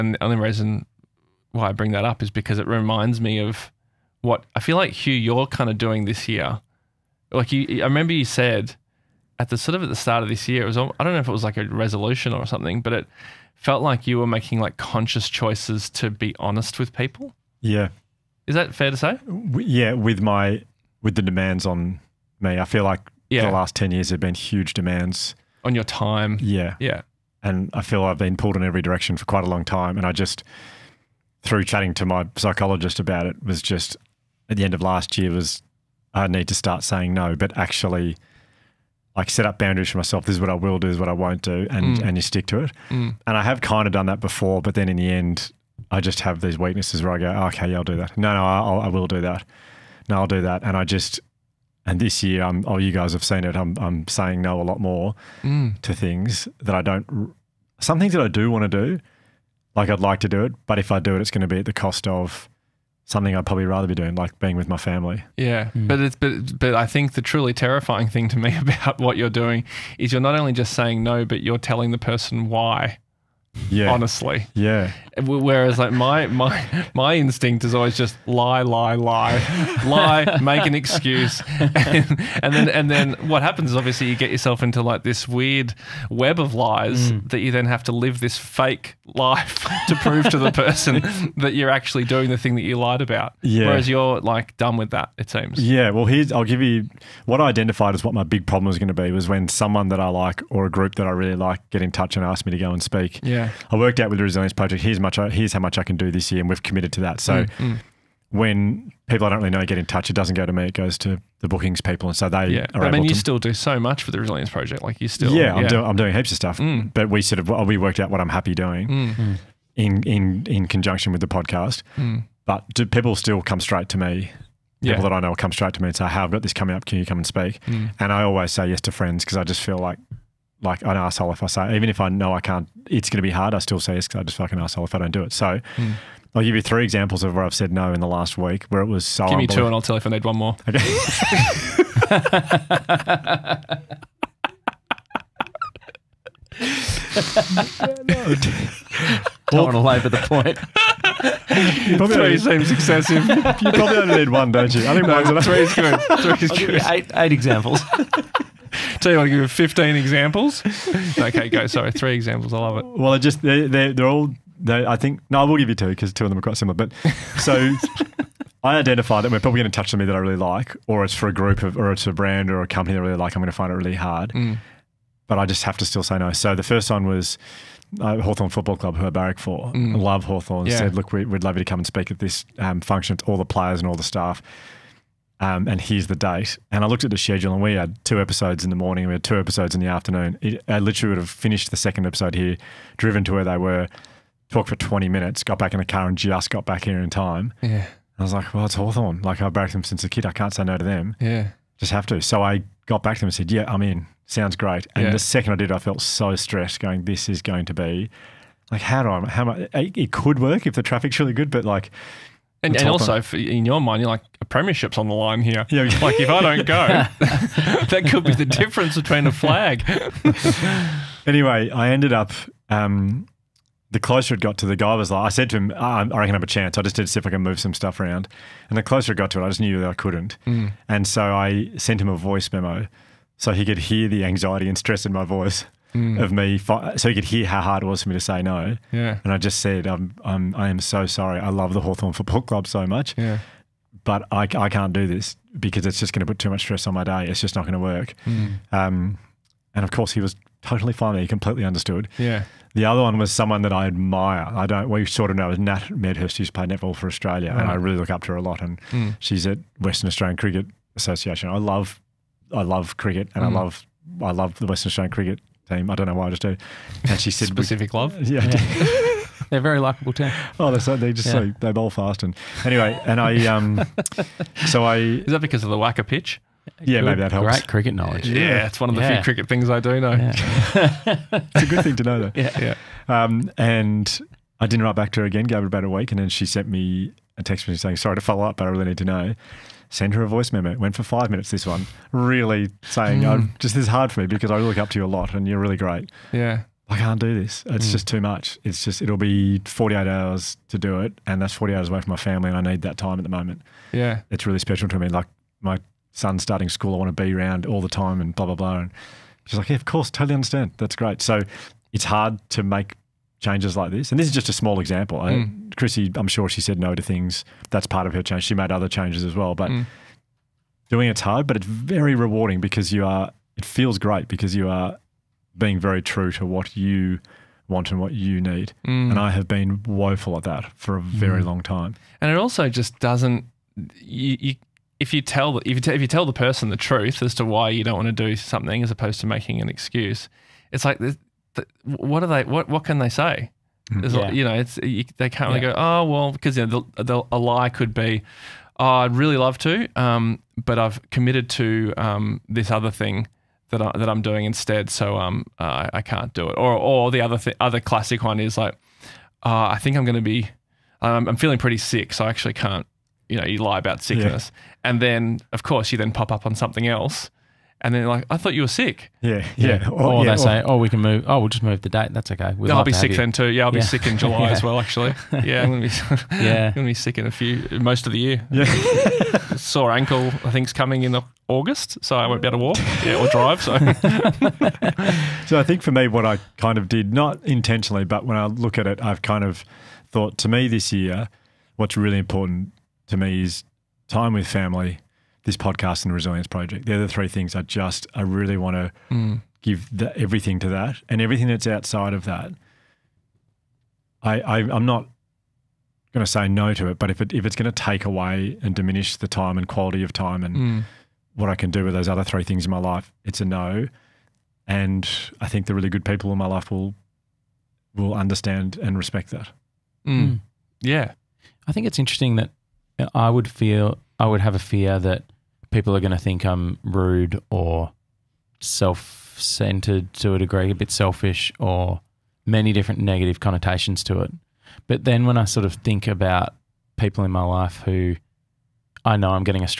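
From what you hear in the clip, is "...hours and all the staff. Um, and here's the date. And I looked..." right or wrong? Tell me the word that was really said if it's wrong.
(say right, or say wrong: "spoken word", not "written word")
wrong: "players", not "hours".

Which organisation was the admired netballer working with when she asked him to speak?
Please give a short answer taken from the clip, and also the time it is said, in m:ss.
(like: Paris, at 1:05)
Western Australian Cricket Association, at 4:19.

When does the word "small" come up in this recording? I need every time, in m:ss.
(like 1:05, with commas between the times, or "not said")
5:14.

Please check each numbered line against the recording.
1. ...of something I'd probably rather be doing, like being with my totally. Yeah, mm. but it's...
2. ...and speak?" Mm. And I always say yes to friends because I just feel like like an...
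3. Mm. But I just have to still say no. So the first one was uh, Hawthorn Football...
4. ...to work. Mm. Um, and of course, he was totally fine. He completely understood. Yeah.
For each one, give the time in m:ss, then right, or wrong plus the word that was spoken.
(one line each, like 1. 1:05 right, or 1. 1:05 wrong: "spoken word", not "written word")
1. 1:02 wrong: "family", not "totally"
2. 2:07 right
3. 2:54 right
4. 4:07 right.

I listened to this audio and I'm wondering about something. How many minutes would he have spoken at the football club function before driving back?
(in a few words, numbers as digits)
20.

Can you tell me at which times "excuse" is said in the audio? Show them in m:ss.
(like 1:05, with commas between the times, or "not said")
1:20, 5:39.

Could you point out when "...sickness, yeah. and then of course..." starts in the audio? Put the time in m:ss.
6:04.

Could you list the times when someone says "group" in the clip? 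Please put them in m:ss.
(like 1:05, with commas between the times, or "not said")
1:40, 2:51.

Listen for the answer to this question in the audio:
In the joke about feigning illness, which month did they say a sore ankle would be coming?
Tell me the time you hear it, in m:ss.
6:21.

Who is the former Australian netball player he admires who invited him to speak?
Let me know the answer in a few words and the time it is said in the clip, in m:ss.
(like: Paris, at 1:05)
Nat Medhurst, at 4:15.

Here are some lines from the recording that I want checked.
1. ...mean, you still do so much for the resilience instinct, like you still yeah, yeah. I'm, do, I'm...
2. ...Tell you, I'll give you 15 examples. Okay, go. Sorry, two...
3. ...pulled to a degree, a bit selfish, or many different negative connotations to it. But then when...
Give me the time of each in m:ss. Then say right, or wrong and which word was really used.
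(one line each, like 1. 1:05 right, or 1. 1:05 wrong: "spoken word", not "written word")
1. 1:52 wrong: "project", not "instinct"
2. 2:39 wrong: "three", not "two"
3. 7:09 wrong: "centered", not "pulled".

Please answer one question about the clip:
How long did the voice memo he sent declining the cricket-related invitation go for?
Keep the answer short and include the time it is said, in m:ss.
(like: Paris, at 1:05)
5 minutes, at 4:51.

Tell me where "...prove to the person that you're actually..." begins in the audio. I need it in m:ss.
1:29.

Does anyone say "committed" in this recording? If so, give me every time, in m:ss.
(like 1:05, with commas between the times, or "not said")
1:46, 5:51.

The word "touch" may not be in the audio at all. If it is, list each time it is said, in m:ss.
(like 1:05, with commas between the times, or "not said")
1:41, 1:49, 2:49.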